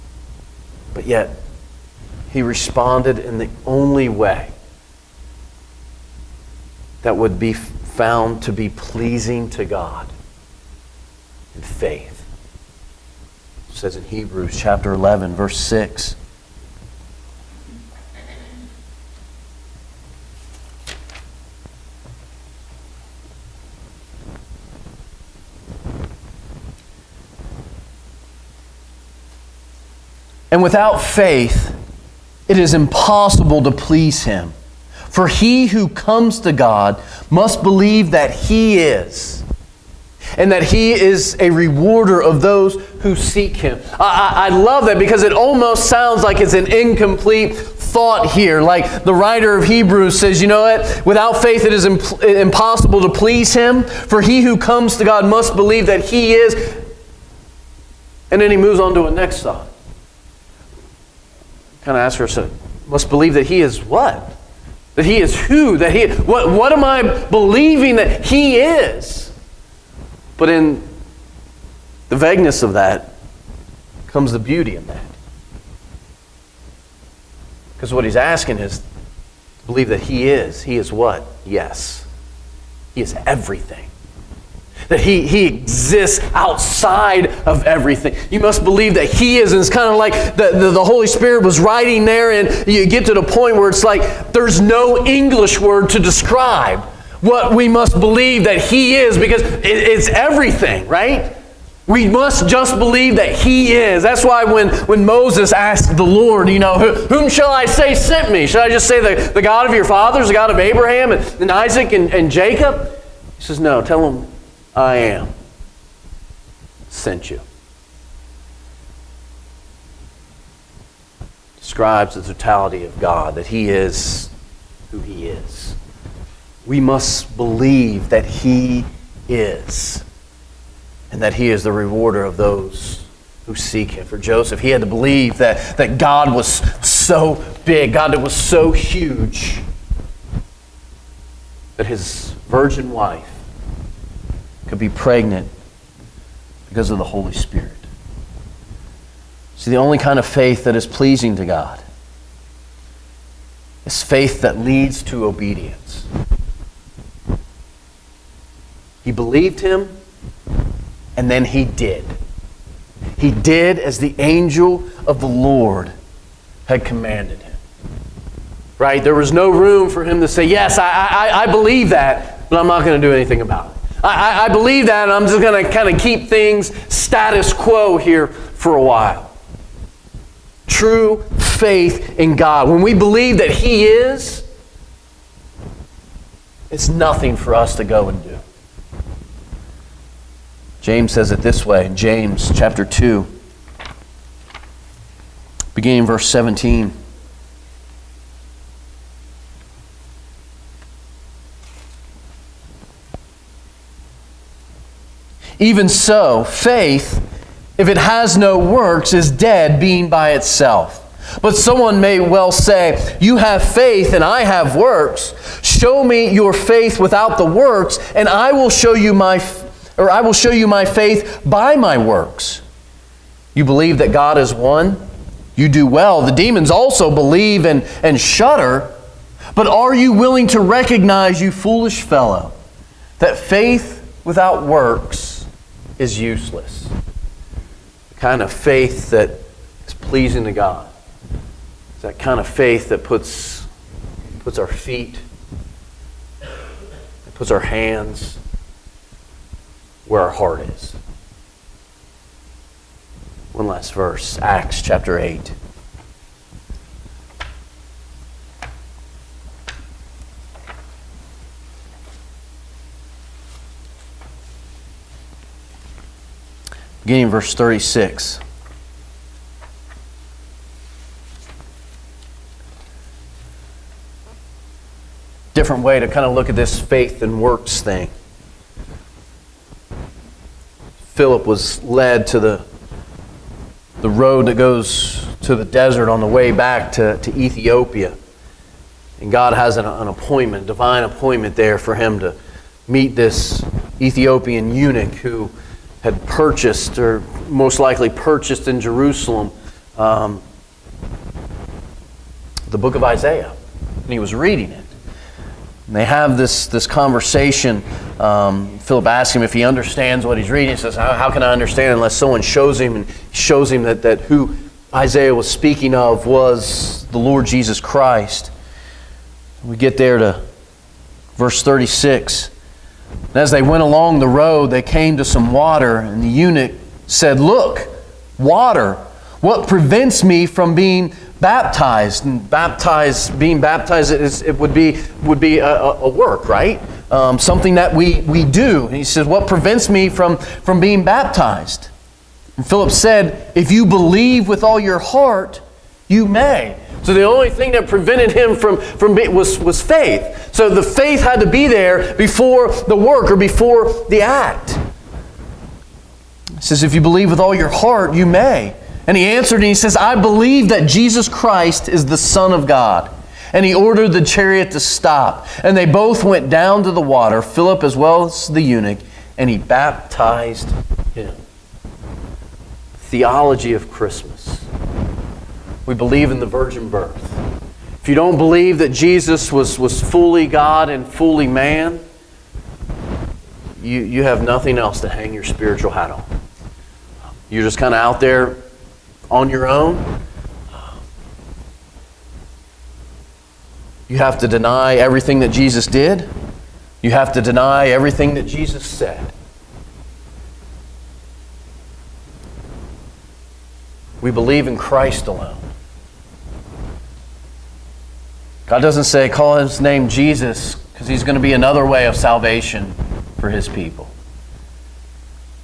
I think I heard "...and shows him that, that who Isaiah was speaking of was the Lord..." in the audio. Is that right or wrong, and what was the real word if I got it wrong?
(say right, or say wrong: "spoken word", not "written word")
right.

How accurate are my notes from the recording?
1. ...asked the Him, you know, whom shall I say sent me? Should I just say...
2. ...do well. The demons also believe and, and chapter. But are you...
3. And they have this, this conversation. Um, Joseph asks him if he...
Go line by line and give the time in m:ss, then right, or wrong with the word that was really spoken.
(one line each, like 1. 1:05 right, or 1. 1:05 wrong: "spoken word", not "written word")
1. 1:45 wrong: "Lord", not "Him"
2. 3:45 wrong: "shudder", not "chapter"
3. 5:05 wrong: "Philip", not "Joseph".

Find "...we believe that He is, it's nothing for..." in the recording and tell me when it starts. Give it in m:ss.
3:02.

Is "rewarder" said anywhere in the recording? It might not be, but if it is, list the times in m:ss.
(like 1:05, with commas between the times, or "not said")
0:41, 2:11.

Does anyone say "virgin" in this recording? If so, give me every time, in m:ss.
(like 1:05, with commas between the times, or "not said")
2:22, 6:16.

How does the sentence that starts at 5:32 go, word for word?
And baptized, being baptized, it would be, would be a, a work, right?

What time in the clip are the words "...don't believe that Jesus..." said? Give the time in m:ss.
6:18.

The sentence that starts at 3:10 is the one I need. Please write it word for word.
James says it this way in James chapter 2, beginning verse 17.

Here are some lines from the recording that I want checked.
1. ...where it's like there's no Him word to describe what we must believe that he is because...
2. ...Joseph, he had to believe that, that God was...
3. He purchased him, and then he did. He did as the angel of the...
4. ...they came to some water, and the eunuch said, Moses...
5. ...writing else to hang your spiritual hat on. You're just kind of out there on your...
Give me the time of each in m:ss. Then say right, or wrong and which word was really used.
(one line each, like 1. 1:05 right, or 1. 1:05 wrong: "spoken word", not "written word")
1. 1:33 wrong: "English", not "Him"
2. 2:14 right
3. 2:39 wrong: "believed", not "purchased"
4. 5:24 wrong: "Look", not "Moses"
5. 6:24 wrong: "nothing", not "writing".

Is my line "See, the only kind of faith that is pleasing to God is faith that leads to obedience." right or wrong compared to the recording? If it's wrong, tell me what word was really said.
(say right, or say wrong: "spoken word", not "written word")
right.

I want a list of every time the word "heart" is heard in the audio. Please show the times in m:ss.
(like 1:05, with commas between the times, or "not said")
4:10, 5:44, 5:57.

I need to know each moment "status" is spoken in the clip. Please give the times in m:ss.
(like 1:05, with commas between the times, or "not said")
2:56.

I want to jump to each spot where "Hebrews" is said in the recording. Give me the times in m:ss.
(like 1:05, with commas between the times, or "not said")
0:14, 0:49.